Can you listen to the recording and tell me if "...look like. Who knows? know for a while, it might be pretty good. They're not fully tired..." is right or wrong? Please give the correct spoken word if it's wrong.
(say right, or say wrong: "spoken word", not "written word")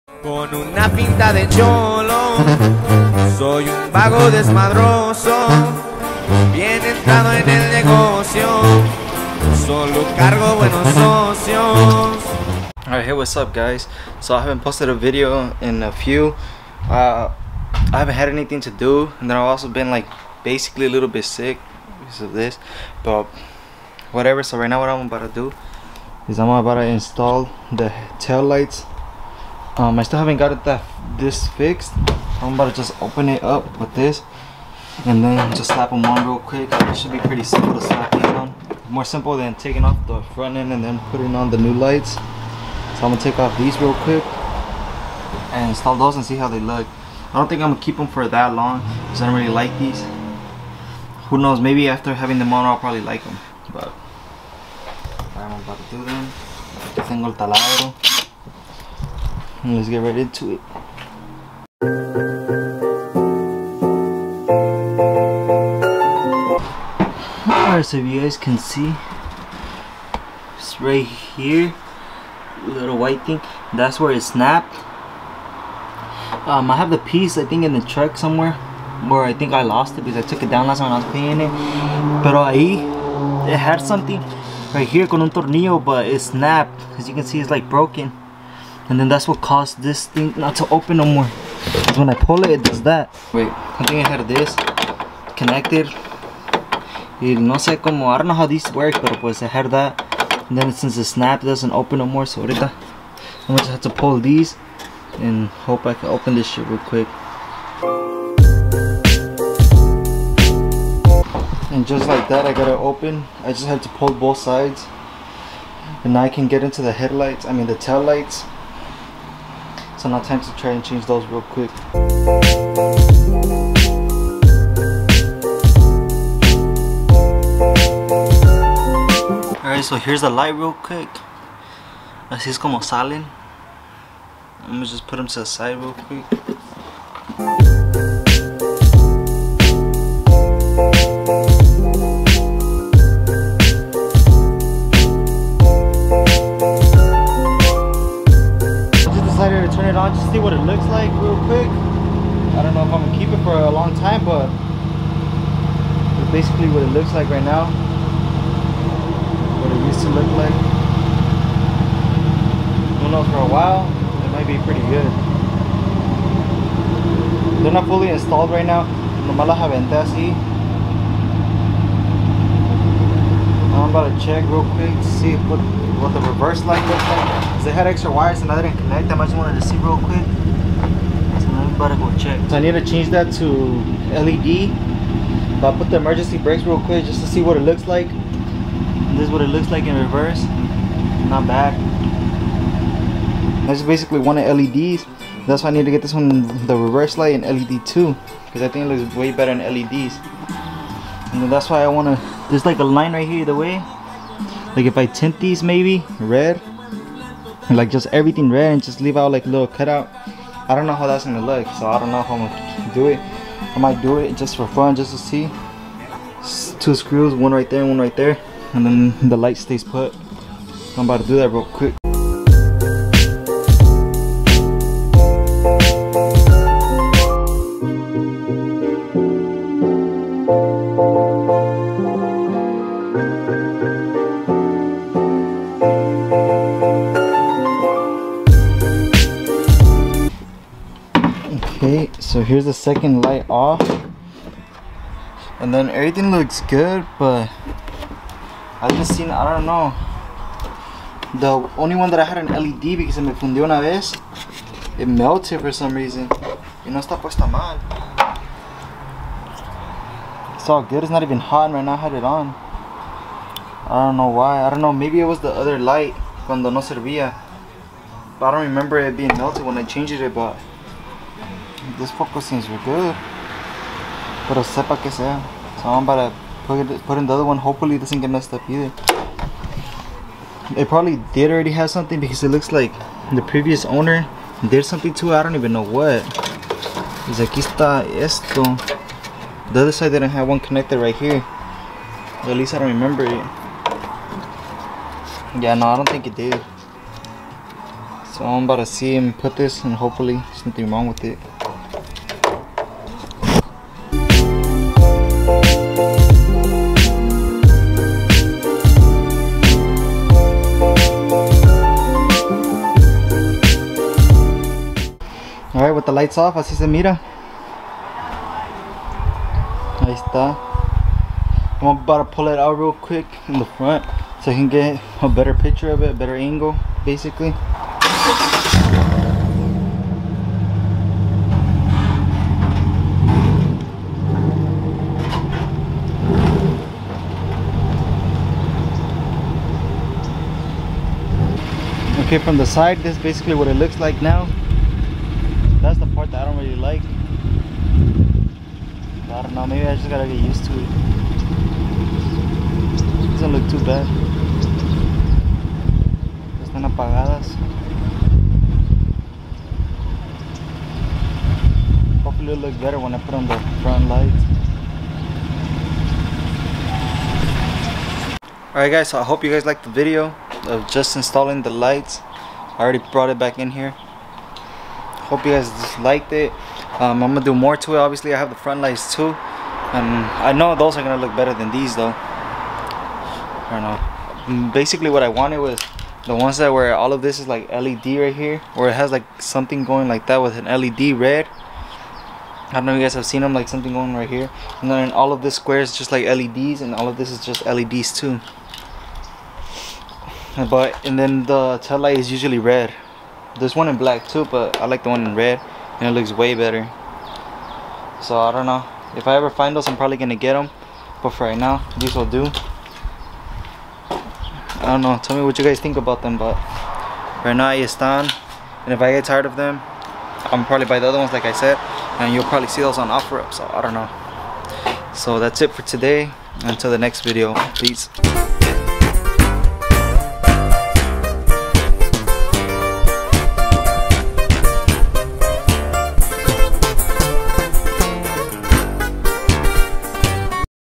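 wrong: "installed", not "tired".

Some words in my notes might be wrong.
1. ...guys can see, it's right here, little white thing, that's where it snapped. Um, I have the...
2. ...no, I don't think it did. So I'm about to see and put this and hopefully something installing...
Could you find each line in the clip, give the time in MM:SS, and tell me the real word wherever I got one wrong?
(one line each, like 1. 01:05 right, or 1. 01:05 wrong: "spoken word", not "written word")
1. 01:08 right
2. 04:55 wrong: "nothing", not "installing".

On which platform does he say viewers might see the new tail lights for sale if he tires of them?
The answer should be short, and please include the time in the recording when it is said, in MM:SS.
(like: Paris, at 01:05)
OfferUp, at 07:03.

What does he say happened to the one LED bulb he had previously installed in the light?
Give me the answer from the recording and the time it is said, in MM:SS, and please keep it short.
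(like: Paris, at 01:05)
It melted, at 04:14.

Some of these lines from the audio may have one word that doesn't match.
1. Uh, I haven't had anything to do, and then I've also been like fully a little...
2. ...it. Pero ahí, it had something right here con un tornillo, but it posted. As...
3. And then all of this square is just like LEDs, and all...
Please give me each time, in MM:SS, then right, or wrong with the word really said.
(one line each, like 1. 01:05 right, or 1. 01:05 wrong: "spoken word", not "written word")
1. 00:16 wrong: "basically", not "fully"
2. 01:21 wrong: "snapped", not "posted"
3. 06:34 right.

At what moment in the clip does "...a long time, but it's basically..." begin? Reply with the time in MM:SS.
02:33.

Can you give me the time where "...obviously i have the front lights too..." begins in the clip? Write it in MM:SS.
06:17.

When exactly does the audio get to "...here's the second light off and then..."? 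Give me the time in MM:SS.
04:02.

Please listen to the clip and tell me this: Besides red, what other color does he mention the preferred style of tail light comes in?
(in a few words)
Black.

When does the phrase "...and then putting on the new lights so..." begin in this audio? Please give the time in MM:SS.
00:40.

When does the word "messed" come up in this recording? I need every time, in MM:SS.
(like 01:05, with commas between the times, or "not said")
04:38.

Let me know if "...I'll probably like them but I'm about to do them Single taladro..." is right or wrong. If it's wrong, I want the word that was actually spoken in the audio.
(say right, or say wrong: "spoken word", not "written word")
right.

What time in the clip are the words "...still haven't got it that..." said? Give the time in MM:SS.
00:30.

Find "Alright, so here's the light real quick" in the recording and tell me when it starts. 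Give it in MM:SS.
02:09.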